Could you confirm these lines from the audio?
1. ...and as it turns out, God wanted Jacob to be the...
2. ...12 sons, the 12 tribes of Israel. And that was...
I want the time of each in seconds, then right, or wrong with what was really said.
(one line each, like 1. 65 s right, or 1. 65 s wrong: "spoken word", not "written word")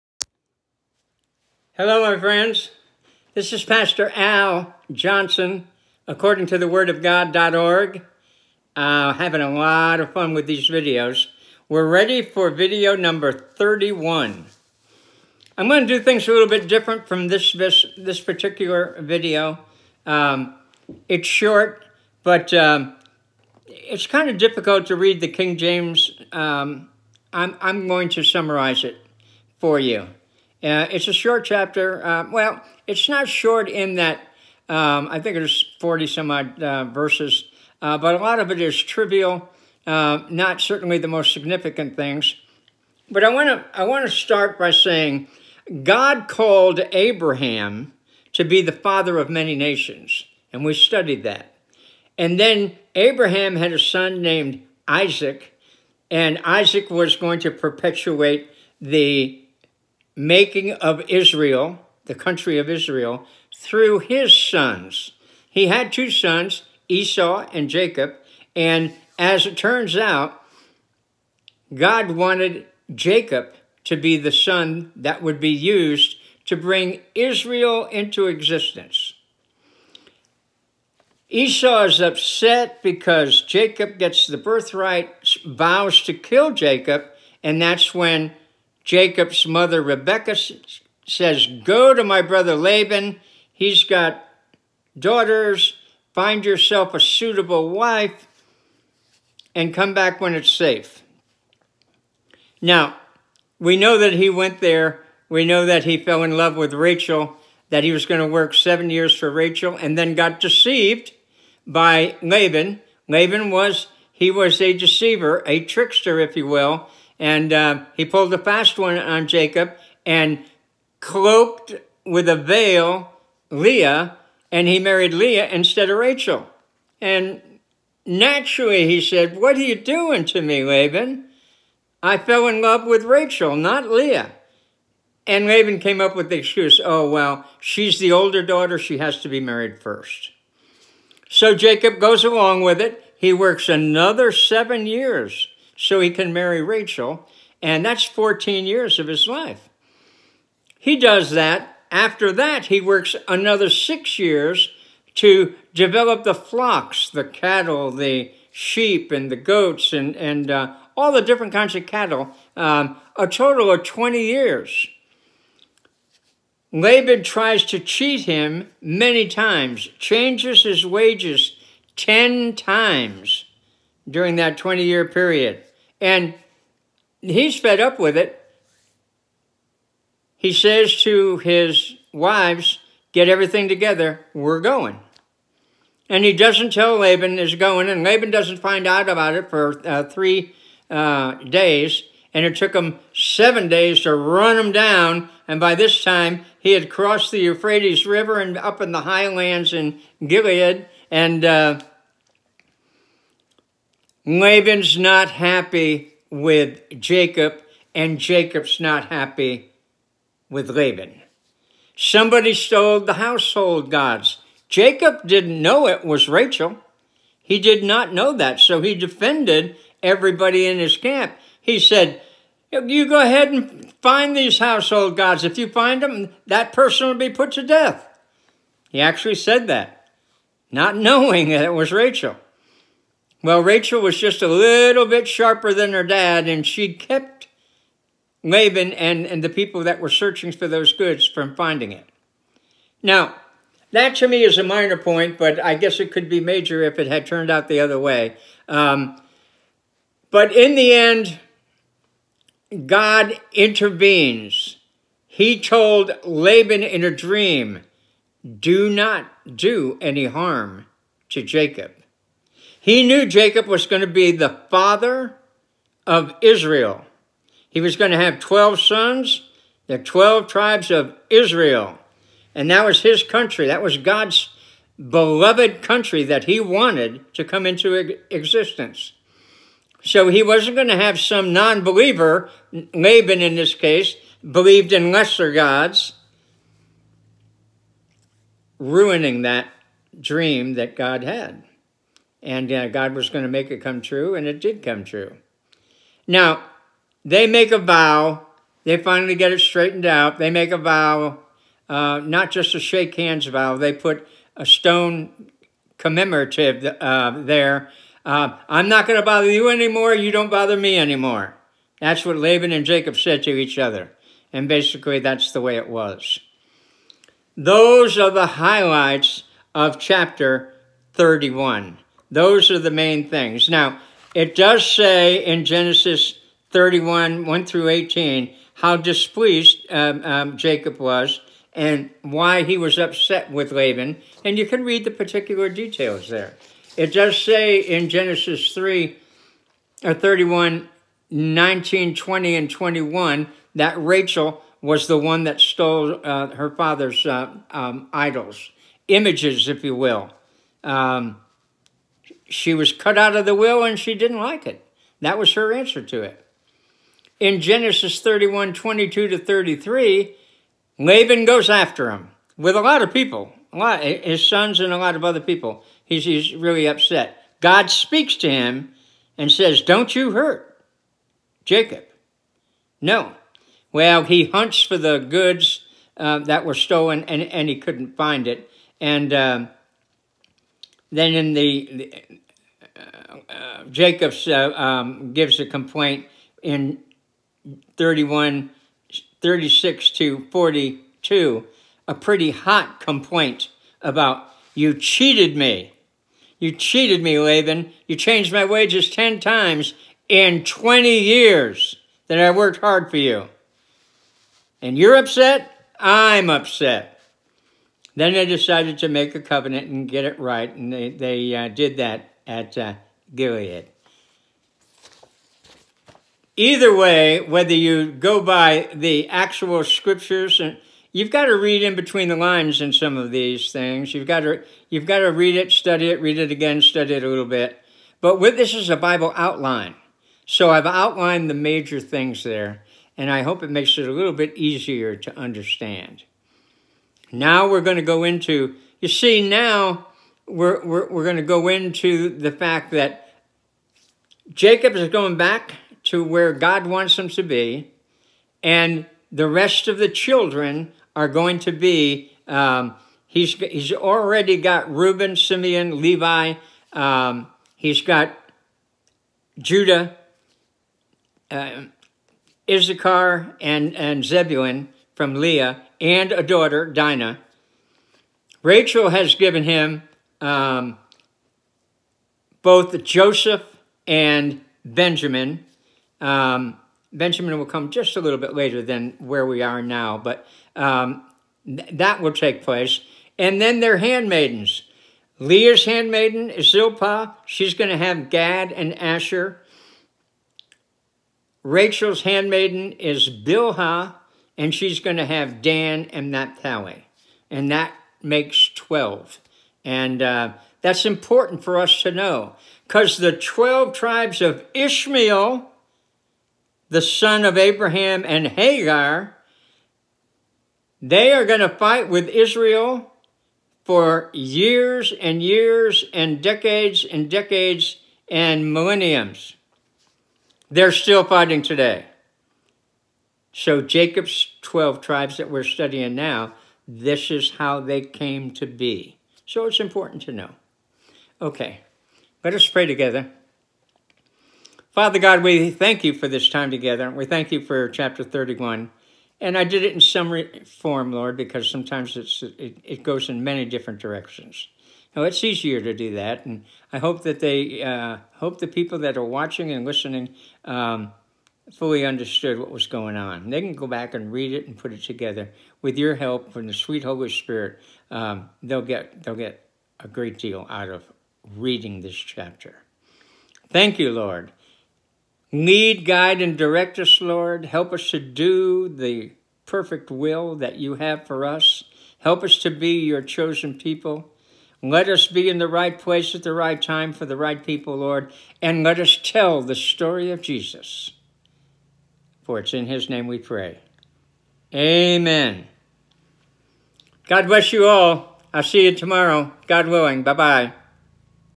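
1. 68 s right
2. 268 s right.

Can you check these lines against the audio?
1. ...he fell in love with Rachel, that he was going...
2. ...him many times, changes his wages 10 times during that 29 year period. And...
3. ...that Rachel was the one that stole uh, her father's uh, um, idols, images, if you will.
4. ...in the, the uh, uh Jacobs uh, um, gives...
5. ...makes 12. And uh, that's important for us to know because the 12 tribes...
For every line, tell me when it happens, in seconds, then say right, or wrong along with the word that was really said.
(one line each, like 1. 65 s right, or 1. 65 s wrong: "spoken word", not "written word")
1. 105 s right
2. 168 s wrong: "20", not "29"
3. 343 s right
4. 381 s right
5. 498 s right.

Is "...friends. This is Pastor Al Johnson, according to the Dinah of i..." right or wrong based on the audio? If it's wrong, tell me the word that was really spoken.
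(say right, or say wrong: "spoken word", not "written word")
wrong: "Word", not "Dinah".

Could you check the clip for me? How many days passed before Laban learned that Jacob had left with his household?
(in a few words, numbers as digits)
3.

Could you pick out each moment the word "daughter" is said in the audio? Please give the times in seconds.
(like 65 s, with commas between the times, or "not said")
94 s, 138 s, 466 s.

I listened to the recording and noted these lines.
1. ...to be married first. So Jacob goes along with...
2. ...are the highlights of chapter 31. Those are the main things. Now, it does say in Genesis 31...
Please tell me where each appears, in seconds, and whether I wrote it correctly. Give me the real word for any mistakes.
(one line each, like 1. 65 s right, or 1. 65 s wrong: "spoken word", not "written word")
1. 139 s right
2. 318 s right.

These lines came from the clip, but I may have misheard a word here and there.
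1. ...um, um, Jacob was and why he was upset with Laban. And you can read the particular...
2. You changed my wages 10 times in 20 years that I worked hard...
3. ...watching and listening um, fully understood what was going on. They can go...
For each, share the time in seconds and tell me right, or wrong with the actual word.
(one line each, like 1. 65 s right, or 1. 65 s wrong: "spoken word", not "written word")
1. 329 s right
2. 398 s right
3. 549 s right.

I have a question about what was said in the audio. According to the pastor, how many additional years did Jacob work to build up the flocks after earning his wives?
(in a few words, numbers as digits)
6.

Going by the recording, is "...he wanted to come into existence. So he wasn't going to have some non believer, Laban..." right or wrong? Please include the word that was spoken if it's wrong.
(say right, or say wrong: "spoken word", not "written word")
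right.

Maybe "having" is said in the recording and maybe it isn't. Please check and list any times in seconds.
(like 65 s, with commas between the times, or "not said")
9 s.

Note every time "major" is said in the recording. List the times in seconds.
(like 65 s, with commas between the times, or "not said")
246 s, 431 s.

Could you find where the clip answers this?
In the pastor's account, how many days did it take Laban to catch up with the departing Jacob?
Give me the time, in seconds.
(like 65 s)
193 s.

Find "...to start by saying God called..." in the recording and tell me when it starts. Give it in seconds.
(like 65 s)
44 s.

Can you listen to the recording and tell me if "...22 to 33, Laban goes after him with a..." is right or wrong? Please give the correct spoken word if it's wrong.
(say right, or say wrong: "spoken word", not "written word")
right.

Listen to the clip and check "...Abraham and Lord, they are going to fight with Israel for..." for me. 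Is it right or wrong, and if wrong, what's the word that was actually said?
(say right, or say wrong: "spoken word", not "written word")
wrong: "Hagar", not "Lord".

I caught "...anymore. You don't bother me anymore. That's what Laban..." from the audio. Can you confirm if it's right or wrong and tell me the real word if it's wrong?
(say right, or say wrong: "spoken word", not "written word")
right.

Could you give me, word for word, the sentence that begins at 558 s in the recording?
Um, they'll get they'll get a great deal out of reading this chapter.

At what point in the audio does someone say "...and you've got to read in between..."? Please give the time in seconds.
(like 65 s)
420 s.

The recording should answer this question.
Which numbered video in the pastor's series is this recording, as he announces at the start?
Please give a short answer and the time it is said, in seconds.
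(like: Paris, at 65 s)
31, at 12 s.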